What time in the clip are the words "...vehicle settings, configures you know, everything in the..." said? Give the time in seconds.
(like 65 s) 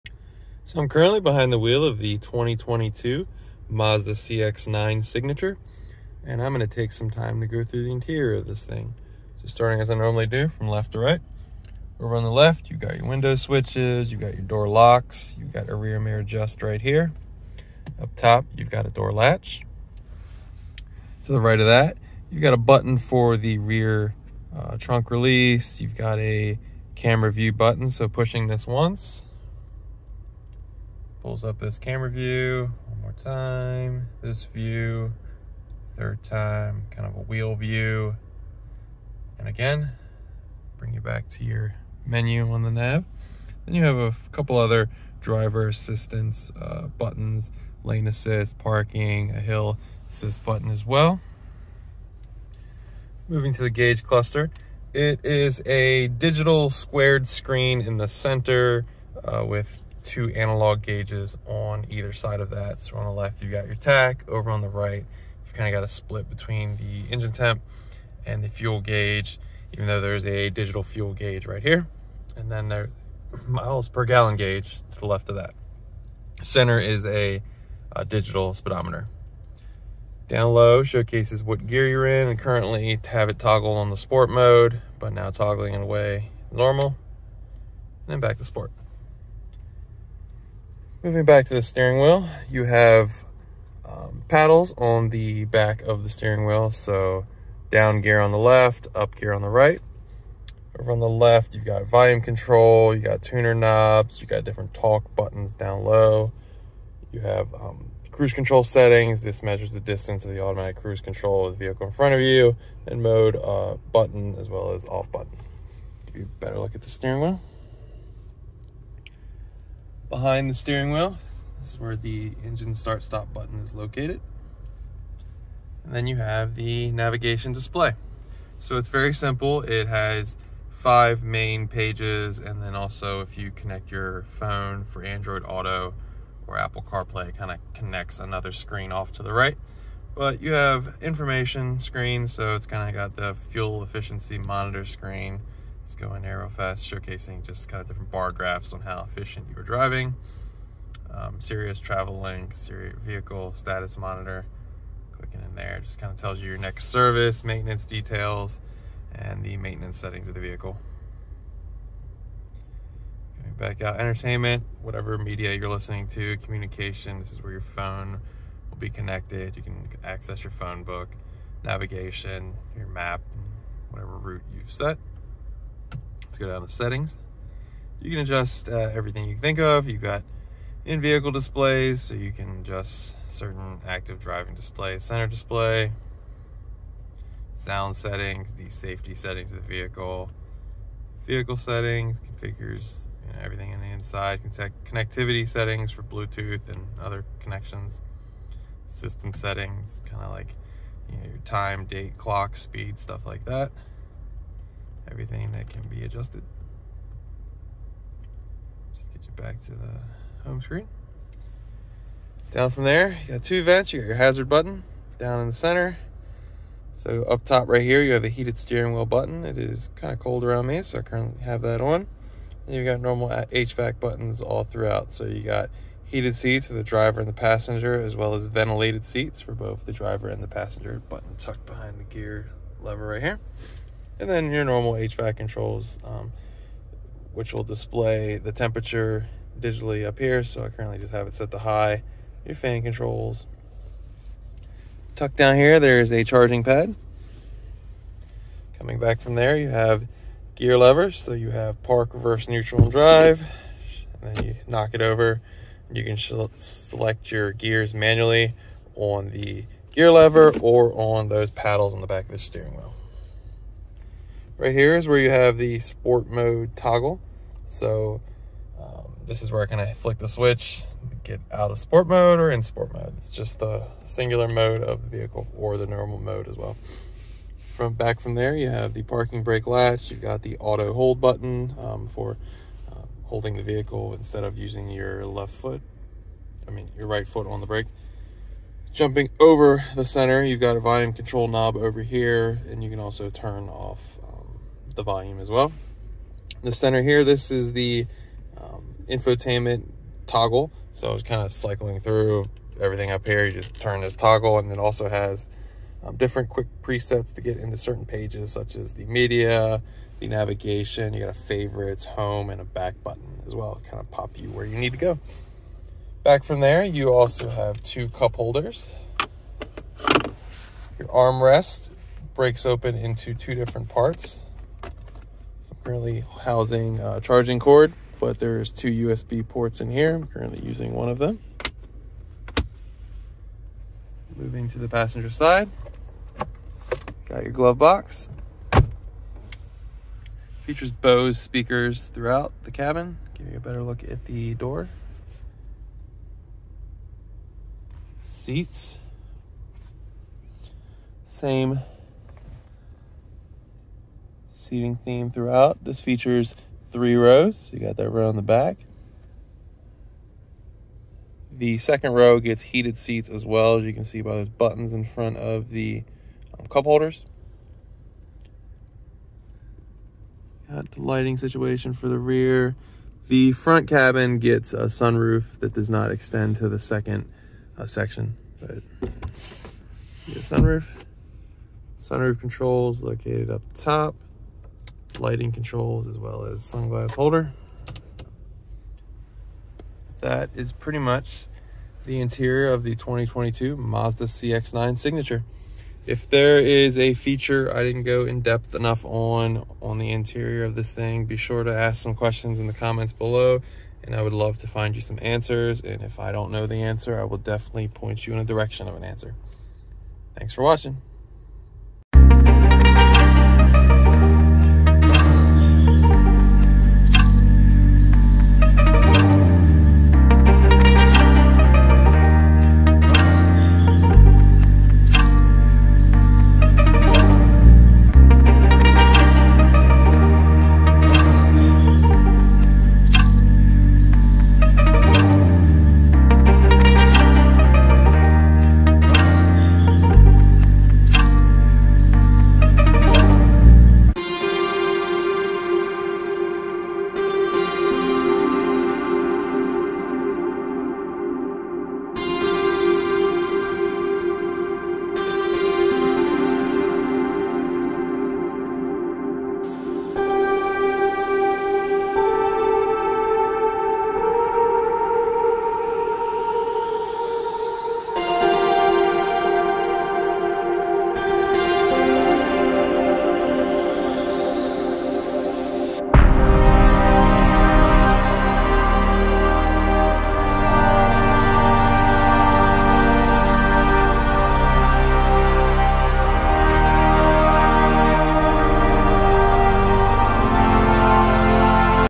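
191 s.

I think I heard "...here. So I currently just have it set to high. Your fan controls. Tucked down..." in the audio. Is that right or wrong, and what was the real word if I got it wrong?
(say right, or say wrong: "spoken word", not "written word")
right.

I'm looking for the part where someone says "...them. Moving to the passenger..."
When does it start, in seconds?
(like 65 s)
331 s.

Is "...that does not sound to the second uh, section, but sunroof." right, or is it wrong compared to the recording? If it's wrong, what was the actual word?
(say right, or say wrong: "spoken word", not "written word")
wrong: "extend", not "sound".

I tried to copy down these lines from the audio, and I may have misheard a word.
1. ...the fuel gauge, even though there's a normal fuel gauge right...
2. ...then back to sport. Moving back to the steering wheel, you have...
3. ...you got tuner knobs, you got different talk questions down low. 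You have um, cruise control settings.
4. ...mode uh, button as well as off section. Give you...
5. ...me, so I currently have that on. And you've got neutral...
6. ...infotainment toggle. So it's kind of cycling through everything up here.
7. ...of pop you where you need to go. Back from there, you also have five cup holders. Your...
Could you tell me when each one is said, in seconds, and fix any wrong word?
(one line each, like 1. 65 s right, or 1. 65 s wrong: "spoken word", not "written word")
1. 68 s wrong: "digital", not "normal"
2. 88 s right
3. 102 s wrong: "buttons", not "questions"
4. 113 s wrong: "button", not "section"
5. 220 s wrong: "normal", not "neutral"
6. 299 s right
7. 313 s wrong: "two", not "five".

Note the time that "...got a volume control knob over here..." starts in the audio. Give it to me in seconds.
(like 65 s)
290 s.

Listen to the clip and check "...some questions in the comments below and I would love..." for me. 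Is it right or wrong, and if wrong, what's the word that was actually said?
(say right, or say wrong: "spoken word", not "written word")
right.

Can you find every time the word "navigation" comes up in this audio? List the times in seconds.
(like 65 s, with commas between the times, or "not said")
126 s, 171 s, 310 s.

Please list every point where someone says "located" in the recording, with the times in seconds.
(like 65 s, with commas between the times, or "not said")
123 s, 383 s.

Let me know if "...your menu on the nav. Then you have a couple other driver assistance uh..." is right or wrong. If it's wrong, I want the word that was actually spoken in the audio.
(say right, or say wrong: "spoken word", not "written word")
right.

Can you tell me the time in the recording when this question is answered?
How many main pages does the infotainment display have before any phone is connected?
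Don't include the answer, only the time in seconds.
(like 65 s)
130 s.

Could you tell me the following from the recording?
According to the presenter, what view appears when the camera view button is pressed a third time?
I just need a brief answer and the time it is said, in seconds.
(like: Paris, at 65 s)
wheel view, at 37 s.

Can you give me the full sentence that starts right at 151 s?
Um, Sirius Travel Link, Sirius Vehicle Status Monitor.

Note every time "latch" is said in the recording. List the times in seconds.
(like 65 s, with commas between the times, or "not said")
19 s, 279 s.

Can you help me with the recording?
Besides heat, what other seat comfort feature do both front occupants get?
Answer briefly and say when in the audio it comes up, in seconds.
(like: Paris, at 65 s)
ventilated seats, at 228 s.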